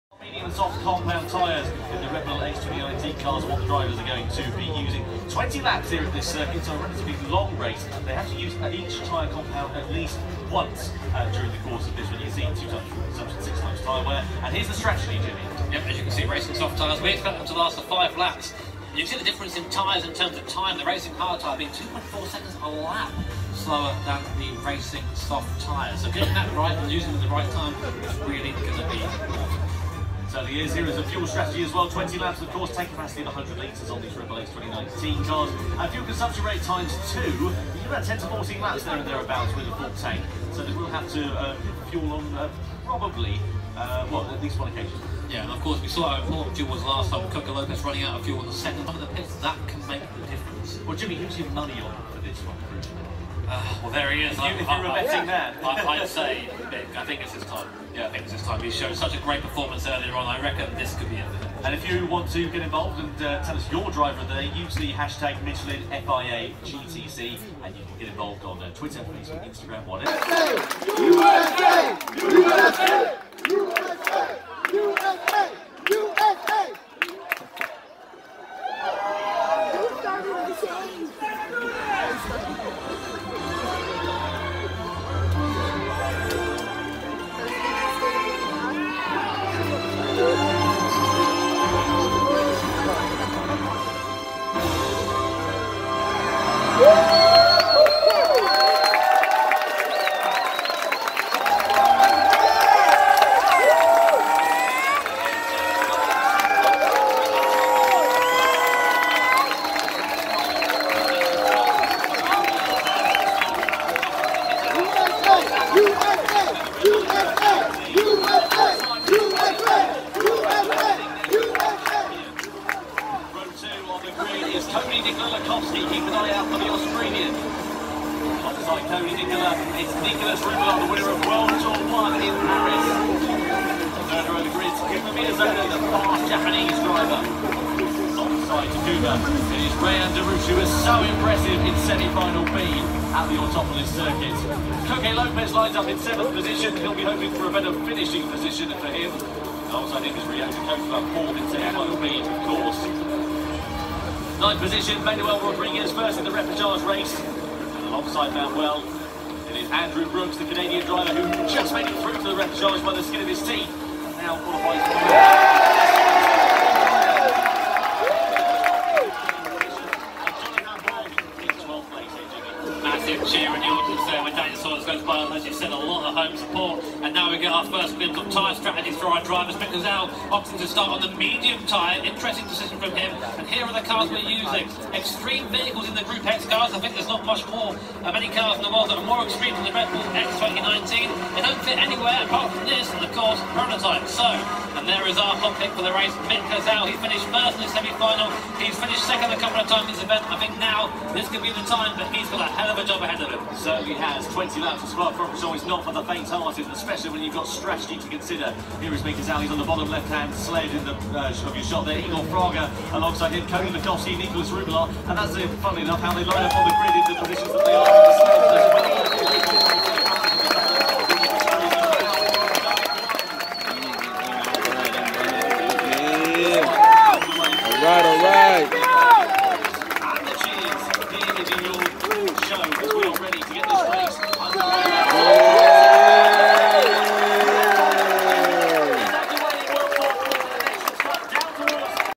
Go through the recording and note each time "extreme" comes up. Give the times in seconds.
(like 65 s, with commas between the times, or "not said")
184 s, 189 s.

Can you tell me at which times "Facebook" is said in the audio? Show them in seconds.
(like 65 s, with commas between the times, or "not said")
68 s.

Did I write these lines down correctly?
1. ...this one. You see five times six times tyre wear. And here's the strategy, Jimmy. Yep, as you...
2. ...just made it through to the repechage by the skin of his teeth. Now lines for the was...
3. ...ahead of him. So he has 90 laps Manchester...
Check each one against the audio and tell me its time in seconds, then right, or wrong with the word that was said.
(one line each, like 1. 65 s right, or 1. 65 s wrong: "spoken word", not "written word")
1. 11 s wrong: "two", not "five"
2. 161 s wrong: "qualifies", not "lines"
3. 203 s wrong: "20", not "90".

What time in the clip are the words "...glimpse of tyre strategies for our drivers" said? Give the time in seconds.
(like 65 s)
177 s.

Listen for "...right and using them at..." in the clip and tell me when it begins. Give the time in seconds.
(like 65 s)
26 s.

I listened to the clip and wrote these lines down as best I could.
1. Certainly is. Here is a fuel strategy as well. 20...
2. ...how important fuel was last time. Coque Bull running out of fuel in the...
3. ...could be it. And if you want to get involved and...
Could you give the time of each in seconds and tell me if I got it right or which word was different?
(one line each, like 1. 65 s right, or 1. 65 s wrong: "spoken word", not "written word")
1. 30 s right
2. 46 s wrong: "Lopez", not "Bull"
3. 60 s right.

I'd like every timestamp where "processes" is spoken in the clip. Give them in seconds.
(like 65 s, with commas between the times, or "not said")
not said.